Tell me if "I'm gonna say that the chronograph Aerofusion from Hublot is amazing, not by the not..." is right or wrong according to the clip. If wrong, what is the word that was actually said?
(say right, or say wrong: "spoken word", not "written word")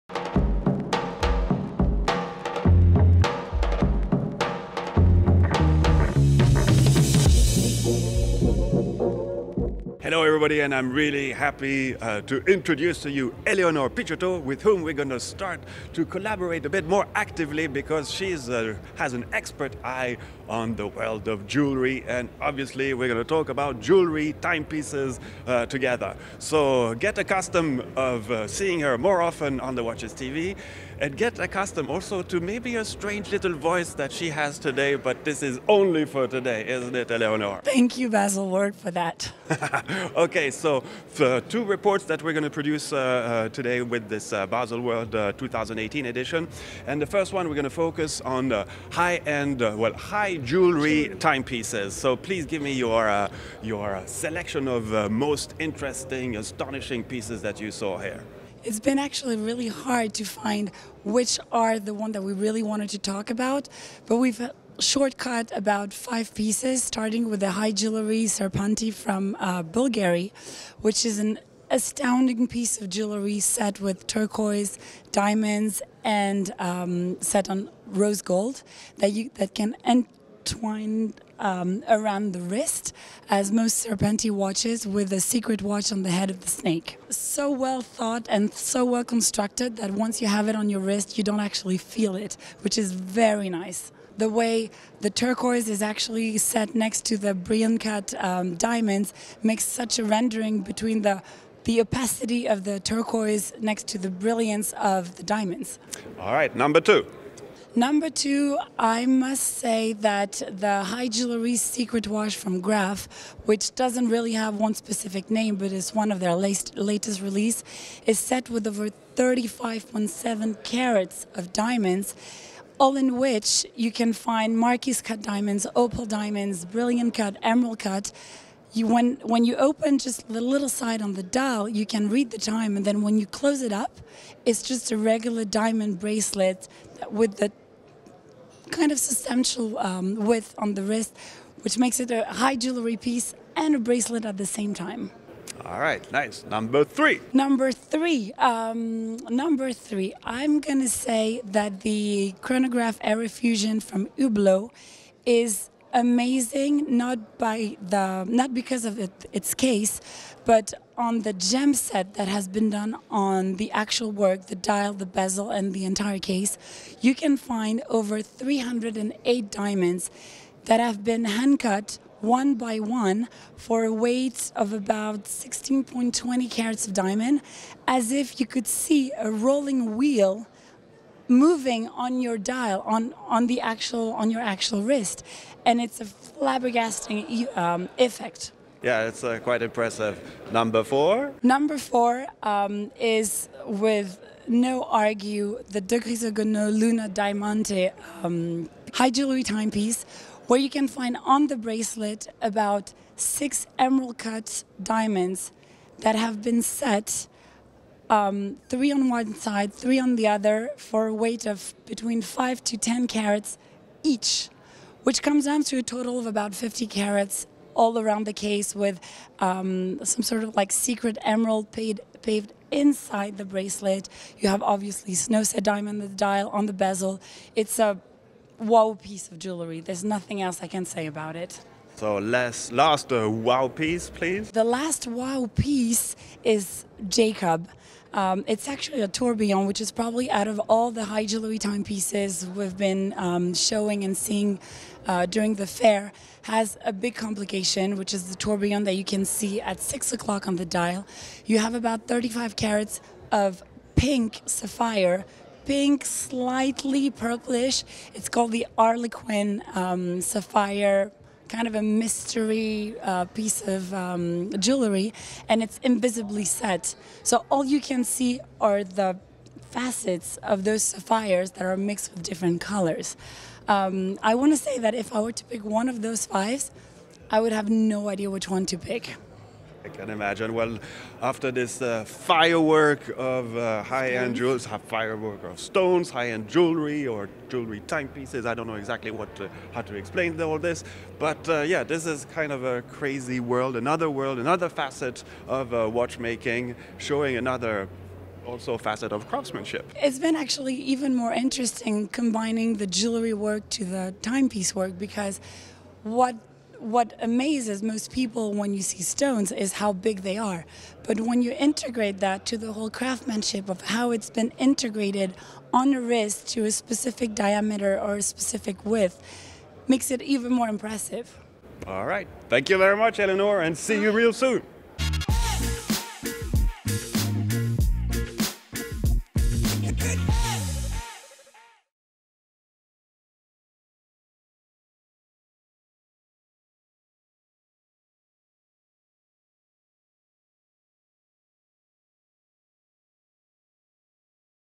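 right.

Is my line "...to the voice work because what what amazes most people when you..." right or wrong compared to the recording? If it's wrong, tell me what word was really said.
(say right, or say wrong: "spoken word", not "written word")
wrong: "timepiece", not "voice".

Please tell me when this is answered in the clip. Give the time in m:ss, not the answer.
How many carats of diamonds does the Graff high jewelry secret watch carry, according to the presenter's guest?
1:59.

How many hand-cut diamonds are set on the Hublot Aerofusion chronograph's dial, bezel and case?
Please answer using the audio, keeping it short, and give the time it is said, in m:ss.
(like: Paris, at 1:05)
308, at 2:48.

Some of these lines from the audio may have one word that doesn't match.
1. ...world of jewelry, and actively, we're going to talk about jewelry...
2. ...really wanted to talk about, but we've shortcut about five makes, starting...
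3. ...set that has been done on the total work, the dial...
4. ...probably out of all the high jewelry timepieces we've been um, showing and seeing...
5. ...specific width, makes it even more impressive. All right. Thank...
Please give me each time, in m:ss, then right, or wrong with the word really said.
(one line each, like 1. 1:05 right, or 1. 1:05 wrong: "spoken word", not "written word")
1. 0:20 wrong: "obviously", not "actively"
2. 1:02 wrong: "pieces", not "makes"
3. 2:41 wrong: "actual", not "total"
4. 3:59 right
5. 5:18 right.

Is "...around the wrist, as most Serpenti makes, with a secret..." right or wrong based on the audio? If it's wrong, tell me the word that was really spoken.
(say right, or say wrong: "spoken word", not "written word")
wrong: "watches", not "makes".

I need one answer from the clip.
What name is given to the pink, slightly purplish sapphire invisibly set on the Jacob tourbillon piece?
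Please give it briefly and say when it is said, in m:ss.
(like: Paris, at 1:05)
Arlequin, at 4:18.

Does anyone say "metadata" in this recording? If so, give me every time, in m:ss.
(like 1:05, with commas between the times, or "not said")
not said.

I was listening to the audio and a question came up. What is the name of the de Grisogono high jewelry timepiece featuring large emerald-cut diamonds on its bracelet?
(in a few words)
Luna Diamante.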